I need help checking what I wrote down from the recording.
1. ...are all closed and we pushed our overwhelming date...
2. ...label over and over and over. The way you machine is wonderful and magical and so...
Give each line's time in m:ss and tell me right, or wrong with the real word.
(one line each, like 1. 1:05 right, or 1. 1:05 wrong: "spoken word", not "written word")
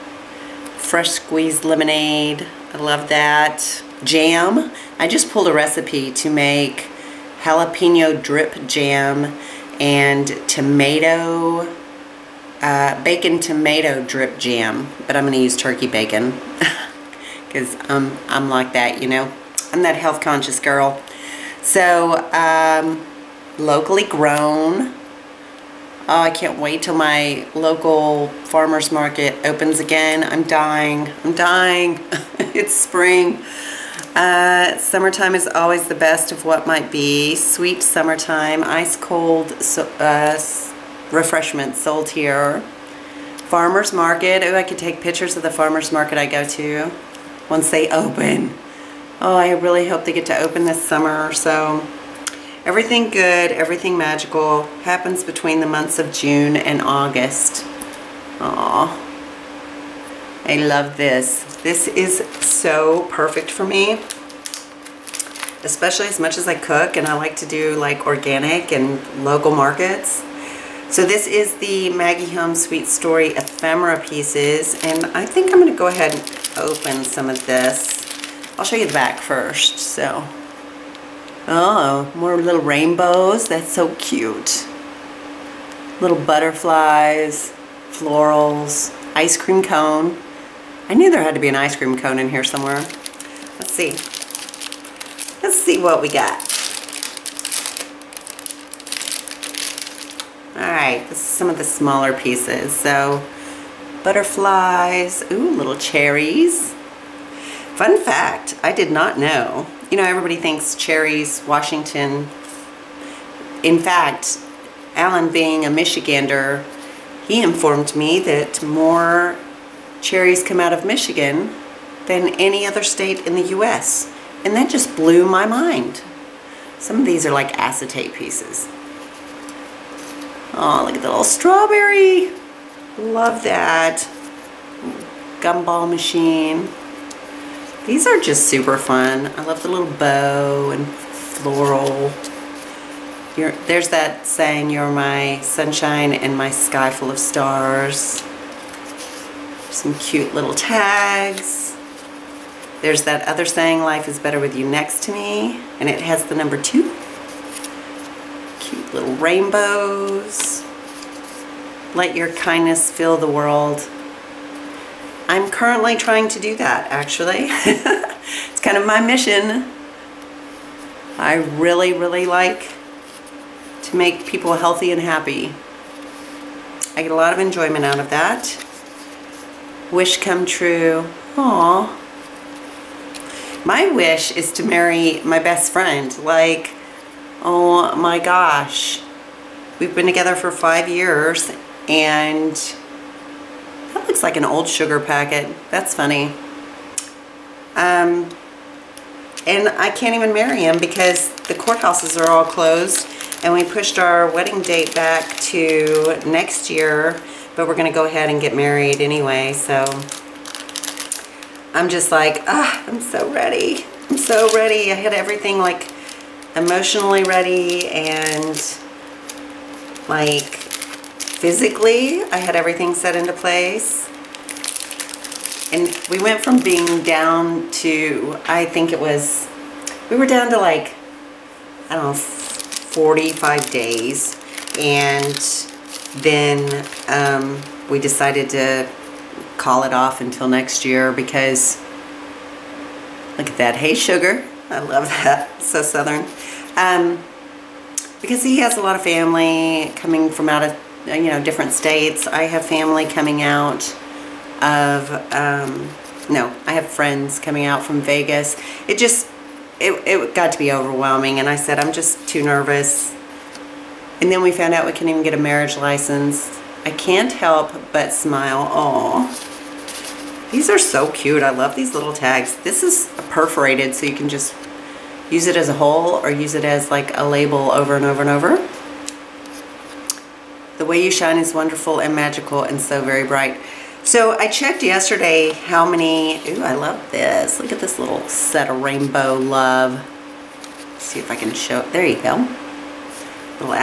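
1. 3:22 wrong: "wedding", not "overwhelming"
2. 4:37 wrong: "shine", not "machine".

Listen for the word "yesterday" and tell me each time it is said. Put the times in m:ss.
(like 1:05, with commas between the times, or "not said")
4:44.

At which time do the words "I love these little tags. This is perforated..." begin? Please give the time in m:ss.
4:31.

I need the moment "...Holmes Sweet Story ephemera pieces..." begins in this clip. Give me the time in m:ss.
1:12.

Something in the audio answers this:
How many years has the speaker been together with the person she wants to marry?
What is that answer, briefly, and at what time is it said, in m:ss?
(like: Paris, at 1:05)
5, at 3:10.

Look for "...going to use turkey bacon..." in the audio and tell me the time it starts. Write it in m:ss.
0:15.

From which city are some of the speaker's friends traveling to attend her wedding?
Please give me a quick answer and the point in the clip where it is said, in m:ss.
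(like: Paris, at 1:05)
Vegas, at 4:17.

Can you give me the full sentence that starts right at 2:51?
I really, really like to make people healthy and happy.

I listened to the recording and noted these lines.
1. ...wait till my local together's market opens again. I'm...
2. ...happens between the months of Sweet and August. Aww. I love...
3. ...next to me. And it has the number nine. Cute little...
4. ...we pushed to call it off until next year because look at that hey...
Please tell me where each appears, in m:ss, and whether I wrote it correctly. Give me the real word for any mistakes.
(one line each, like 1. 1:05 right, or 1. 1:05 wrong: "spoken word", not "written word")
1. 0:26 wrong: "farmer", not "together"
2. 0:54 wrong: "June", not "Sweet"
3. 2:34 wrong: "two", not "nine"
4. 3:57 wrong: "decided", not "pushed".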